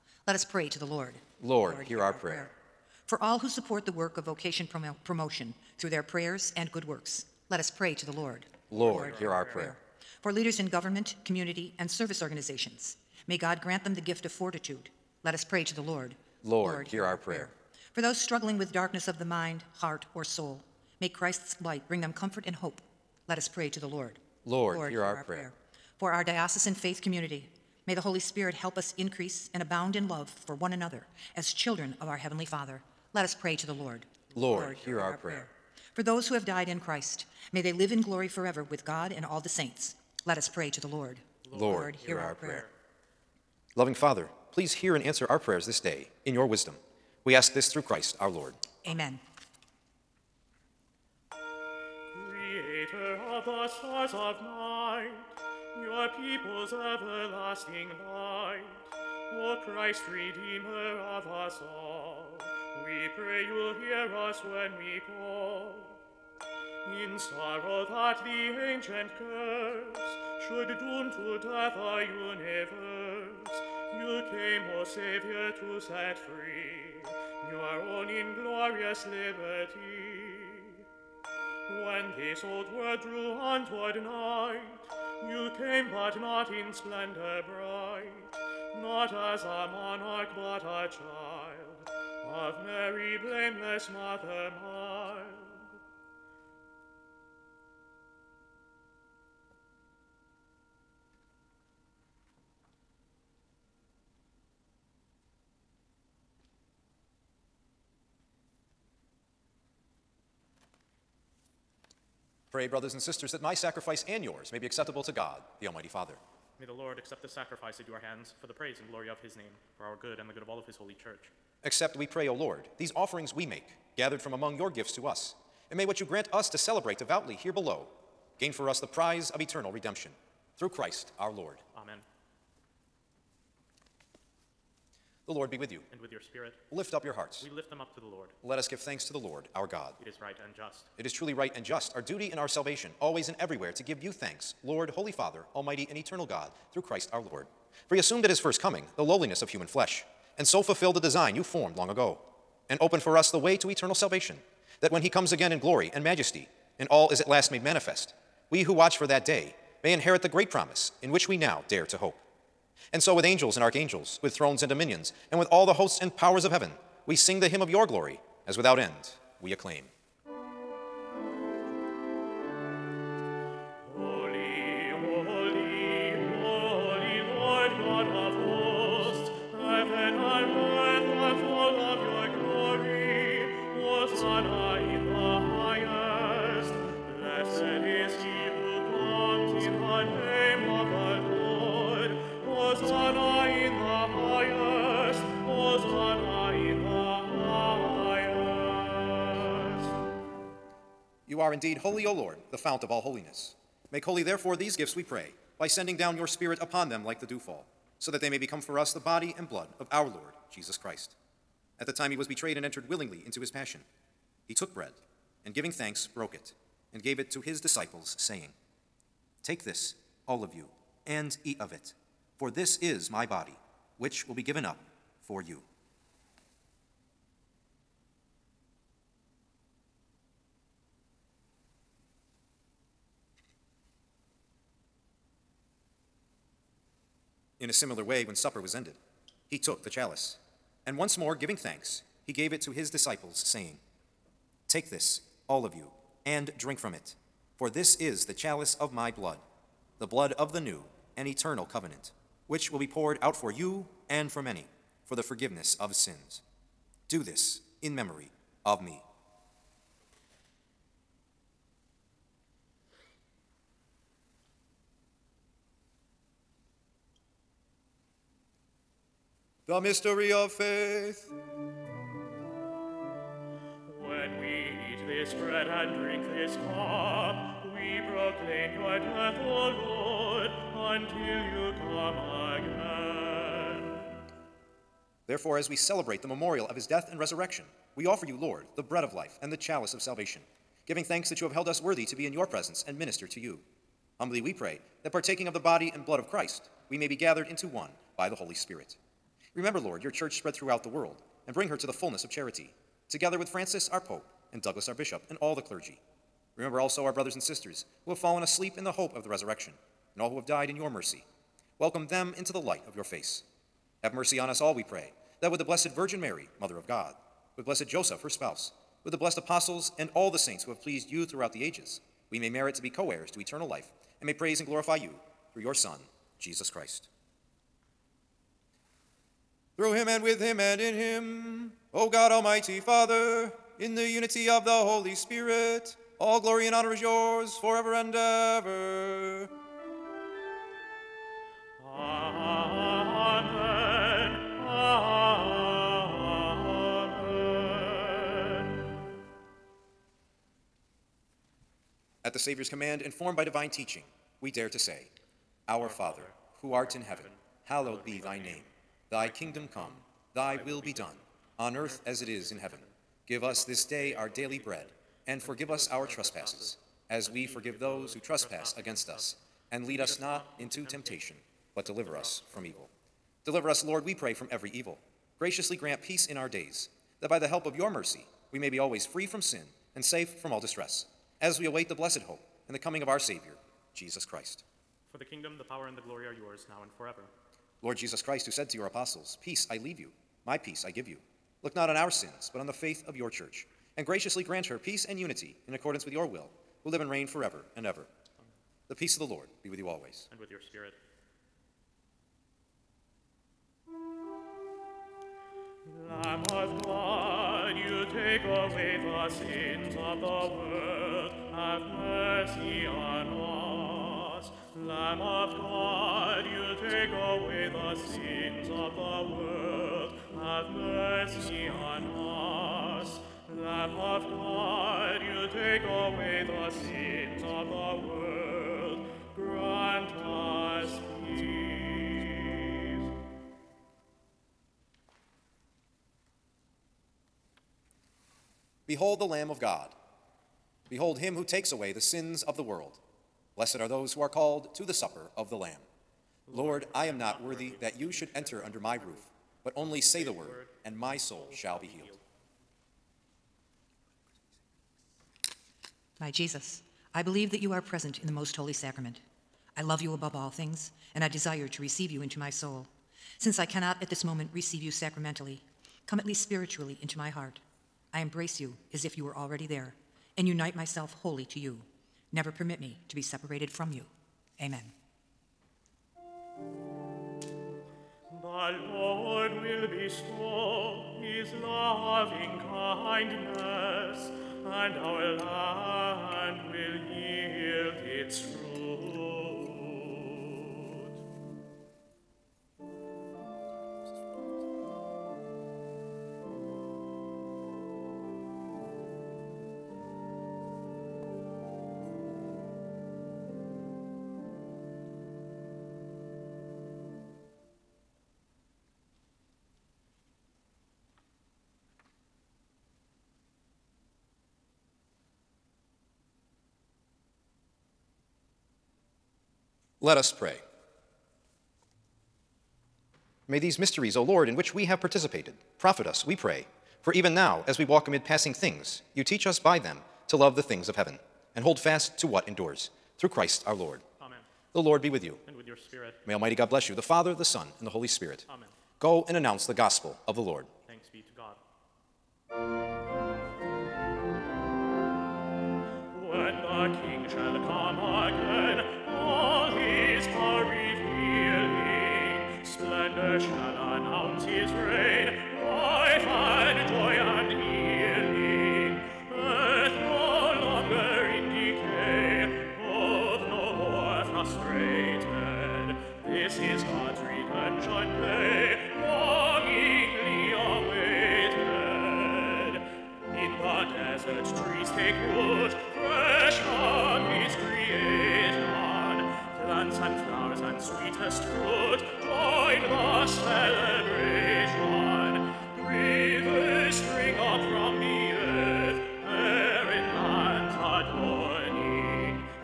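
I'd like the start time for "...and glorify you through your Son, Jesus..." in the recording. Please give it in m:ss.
5:24.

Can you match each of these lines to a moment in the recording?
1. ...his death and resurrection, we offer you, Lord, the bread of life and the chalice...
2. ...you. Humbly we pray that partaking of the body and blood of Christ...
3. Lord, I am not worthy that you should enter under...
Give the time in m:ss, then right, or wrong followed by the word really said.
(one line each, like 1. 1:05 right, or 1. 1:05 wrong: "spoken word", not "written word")
1. 4:46 right
2. 4:53 right
3. 7:26 right.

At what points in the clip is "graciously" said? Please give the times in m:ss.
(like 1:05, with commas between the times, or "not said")
6:15, 6:34.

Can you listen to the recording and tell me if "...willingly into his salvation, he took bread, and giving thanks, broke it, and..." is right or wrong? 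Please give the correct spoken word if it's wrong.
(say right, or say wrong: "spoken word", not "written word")
wrong: "passion", not "salvation".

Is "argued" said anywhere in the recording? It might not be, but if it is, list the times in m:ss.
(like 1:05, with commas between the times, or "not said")
not said.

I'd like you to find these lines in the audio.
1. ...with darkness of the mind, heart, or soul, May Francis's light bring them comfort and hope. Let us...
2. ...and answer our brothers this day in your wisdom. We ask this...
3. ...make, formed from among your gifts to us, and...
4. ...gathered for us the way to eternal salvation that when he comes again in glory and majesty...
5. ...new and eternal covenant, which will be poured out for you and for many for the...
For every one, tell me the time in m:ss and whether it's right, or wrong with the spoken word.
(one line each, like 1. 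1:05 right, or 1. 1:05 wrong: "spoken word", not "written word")
1. 0:18 wrong: "Christ", not "Francis"
2. 0:44 wrong: "prayers", not "brothers"
3. 2:03 wrong: "gathered", not "formed"
4. 2:32 wrong: "opened", not "gathered"
5. 4:10 right.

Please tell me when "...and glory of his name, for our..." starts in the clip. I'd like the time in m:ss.
1:58.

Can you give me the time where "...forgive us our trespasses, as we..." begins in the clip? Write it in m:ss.
6:05.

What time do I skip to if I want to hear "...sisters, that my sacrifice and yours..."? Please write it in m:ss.
1:53.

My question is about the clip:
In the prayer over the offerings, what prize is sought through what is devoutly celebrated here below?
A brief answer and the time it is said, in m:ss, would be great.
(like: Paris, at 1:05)
eternal redemption, at 2:09.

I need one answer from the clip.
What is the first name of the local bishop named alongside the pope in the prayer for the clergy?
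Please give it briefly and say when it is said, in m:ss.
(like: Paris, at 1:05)
Douglas, at 5:04.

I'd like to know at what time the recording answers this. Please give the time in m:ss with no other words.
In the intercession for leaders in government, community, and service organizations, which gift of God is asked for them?
0:14.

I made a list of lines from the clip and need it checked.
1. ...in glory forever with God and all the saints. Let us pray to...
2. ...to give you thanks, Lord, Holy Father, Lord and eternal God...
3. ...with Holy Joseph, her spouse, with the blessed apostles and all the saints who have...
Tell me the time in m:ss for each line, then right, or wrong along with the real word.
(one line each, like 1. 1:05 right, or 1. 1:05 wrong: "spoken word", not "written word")
1. 0:37 right
2. 2:23 wrong: "Almighty", not "Lord"
3. 5:17 wrong: "Blessed", not "Holy".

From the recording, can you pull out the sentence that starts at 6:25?
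For the kingdom, the power, and the glory are yours now and forever.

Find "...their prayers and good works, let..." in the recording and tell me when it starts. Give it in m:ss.
0:05.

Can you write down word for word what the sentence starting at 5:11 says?
Welcome them into the light of your face.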